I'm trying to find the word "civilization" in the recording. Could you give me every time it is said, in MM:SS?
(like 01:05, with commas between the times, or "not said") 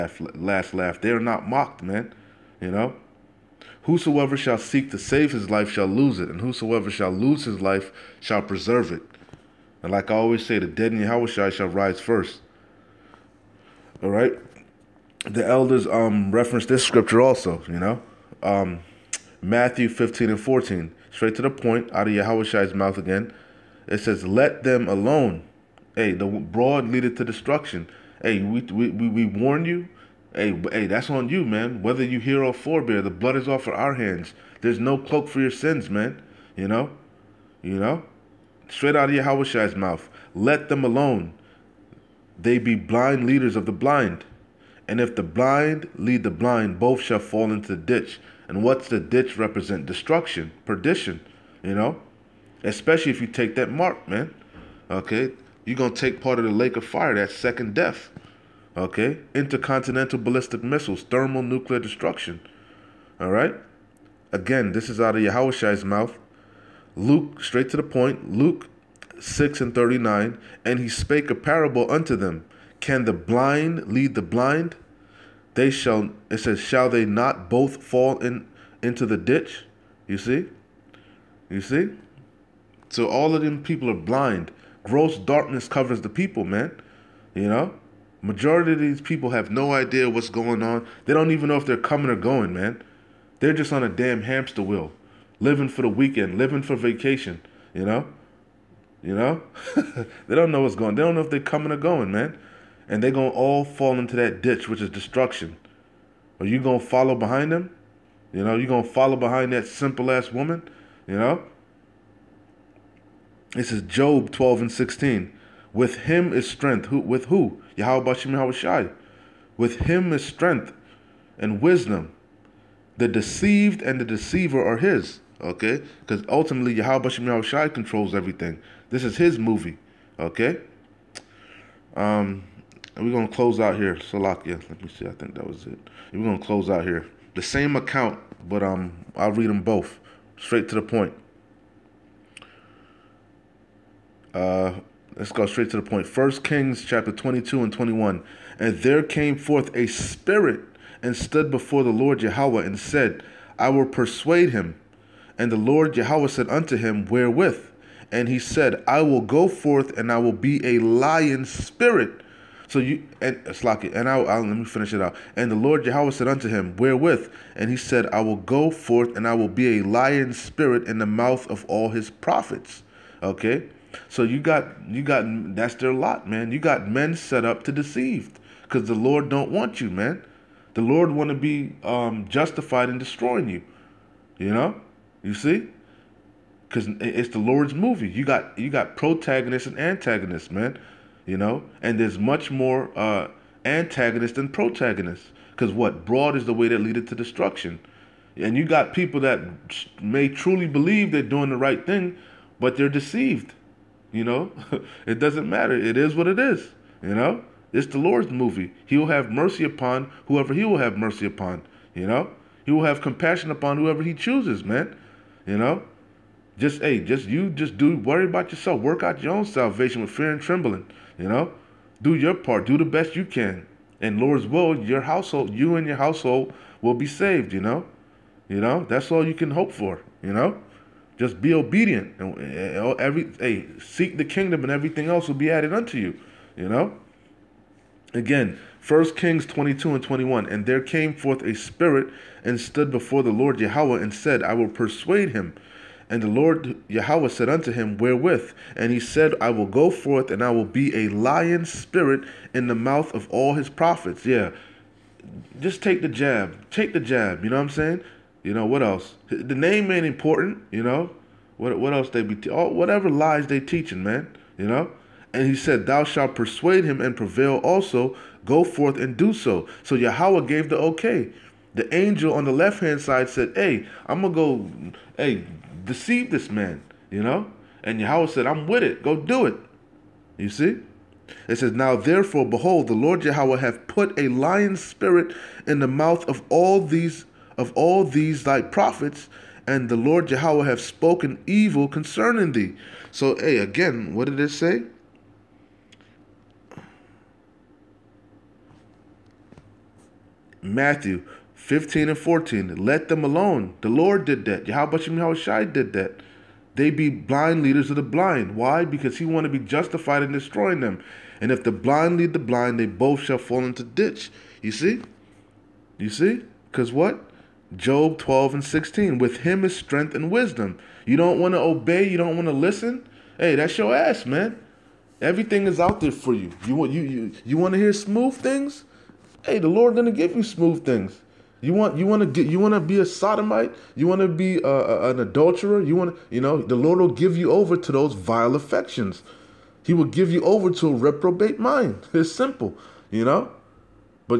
not said.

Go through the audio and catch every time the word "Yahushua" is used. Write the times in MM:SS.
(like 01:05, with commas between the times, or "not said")
00:10, 00:22, 00:39, 01:05.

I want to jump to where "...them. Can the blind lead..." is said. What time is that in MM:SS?
01:12.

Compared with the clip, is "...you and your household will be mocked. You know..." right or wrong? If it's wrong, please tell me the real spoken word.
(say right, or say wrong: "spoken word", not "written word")
wrong: "saved", not "mocked".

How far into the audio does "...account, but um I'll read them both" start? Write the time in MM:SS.
02:17.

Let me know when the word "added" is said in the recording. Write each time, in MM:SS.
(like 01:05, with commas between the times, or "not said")
03:55.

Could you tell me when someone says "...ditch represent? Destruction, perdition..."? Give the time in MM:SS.
00:48.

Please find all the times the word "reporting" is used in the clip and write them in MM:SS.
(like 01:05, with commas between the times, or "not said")
not said.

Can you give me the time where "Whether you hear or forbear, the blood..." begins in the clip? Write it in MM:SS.
00:31.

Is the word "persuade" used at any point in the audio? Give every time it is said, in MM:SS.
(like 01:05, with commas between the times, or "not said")
02:33, 04:04, 04:26.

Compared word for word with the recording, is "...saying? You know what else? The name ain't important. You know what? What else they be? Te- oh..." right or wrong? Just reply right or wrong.
right.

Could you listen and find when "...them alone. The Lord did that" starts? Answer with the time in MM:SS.
05:03.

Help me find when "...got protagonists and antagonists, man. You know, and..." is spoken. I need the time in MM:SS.
03:08.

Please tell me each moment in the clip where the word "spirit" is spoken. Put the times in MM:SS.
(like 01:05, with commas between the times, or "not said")
02:29, 02:41, 02:50, 04:01, 04:11, 04:44.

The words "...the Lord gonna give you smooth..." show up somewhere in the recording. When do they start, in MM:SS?
05:29.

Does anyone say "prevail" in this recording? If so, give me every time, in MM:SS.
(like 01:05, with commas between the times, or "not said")
04:27.